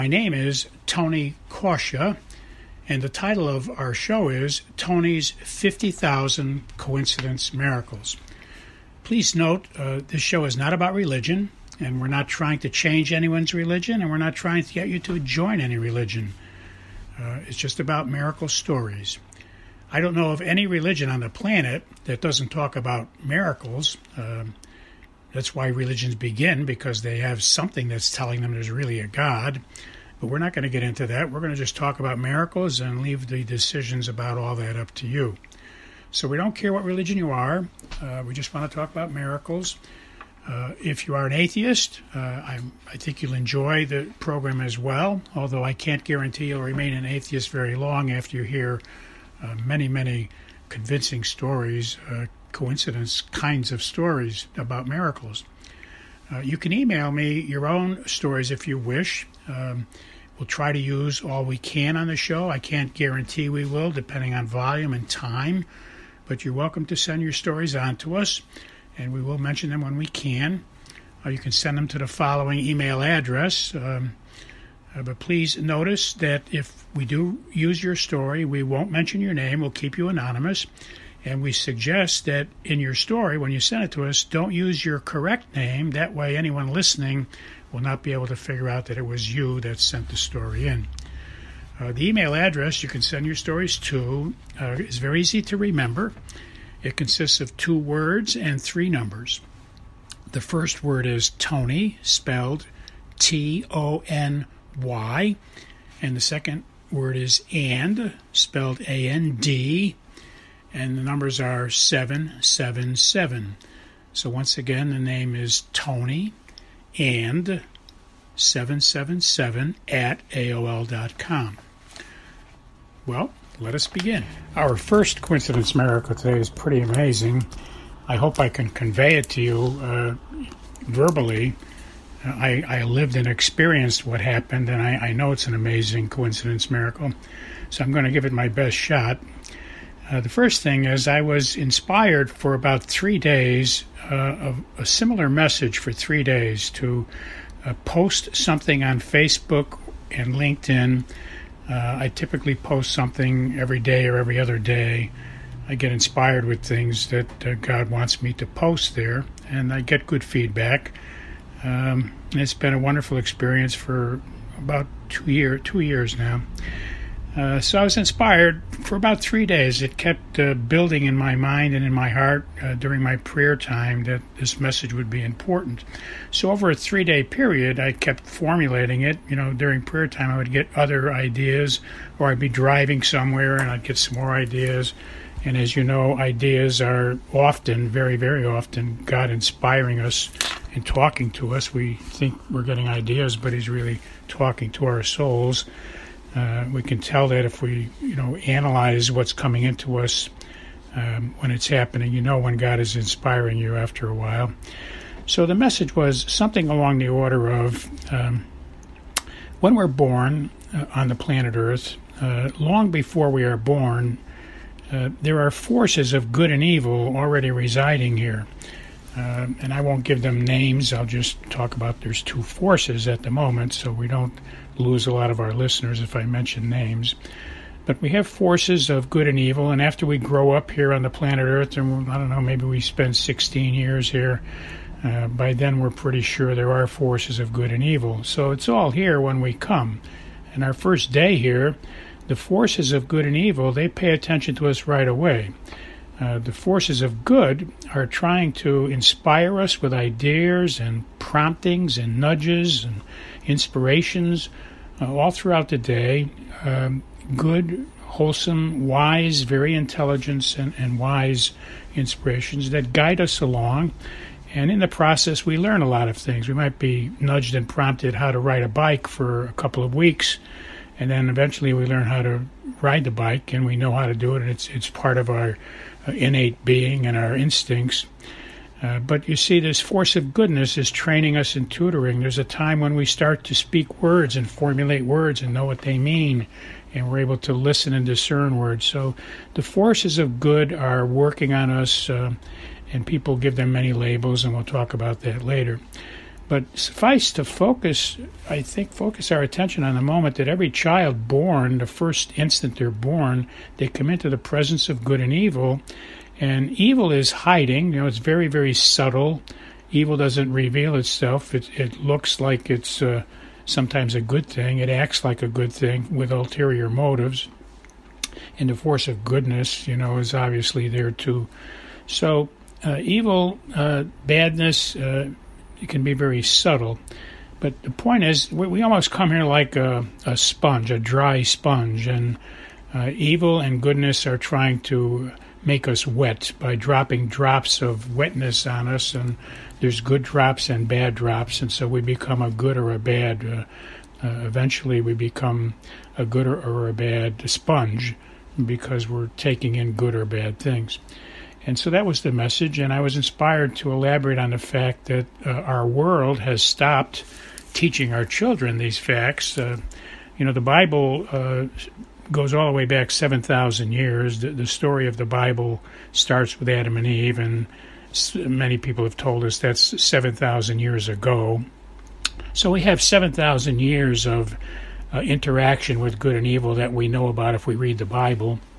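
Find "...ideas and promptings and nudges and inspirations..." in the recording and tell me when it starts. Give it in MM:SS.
04:09.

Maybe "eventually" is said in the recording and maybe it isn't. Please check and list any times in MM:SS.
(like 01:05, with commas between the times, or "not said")
04:31, 05:44.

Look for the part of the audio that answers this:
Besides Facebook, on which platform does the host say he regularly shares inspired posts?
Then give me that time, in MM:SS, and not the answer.
02:30.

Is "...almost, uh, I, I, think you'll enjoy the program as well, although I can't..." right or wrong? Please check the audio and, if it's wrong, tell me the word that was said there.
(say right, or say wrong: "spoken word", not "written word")
wrong: "atheist", not "almost".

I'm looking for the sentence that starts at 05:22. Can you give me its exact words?
So, uh, evil, uh, badness, uh, it can be very subtle.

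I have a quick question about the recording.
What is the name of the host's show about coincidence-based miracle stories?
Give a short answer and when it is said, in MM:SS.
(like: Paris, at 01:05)
Tony's 50,000 Coincidence Miracles, at 00:04.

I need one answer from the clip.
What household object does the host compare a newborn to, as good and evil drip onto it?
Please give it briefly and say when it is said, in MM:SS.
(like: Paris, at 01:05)
a dry sponge, at 05:30.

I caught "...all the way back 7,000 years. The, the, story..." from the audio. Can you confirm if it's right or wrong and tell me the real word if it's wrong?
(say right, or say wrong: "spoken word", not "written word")
right.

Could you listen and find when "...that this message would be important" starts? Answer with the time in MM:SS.
02:54.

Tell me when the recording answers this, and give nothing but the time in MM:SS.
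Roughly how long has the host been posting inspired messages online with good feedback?
02:45.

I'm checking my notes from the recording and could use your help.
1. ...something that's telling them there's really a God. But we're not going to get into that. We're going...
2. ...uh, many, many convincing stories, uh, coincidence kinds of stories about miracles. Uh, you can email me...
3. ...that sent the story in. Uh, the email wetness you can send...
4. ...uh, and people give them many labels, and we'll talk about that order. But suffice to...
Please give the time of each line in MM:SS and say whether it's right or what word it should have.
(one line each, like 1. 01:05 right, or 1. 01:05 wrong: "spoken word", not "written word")
1. 00:27 right
2. 00:49 right
3. 01:29 wrong: "address", not "wetness"
4. 04:52 wrong: "later", not "order".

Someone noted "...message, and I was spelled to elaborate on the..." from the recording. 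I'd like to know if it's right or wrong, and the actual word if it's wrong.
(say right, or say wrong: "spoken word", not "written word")
wrong: "inspired", not "spelled".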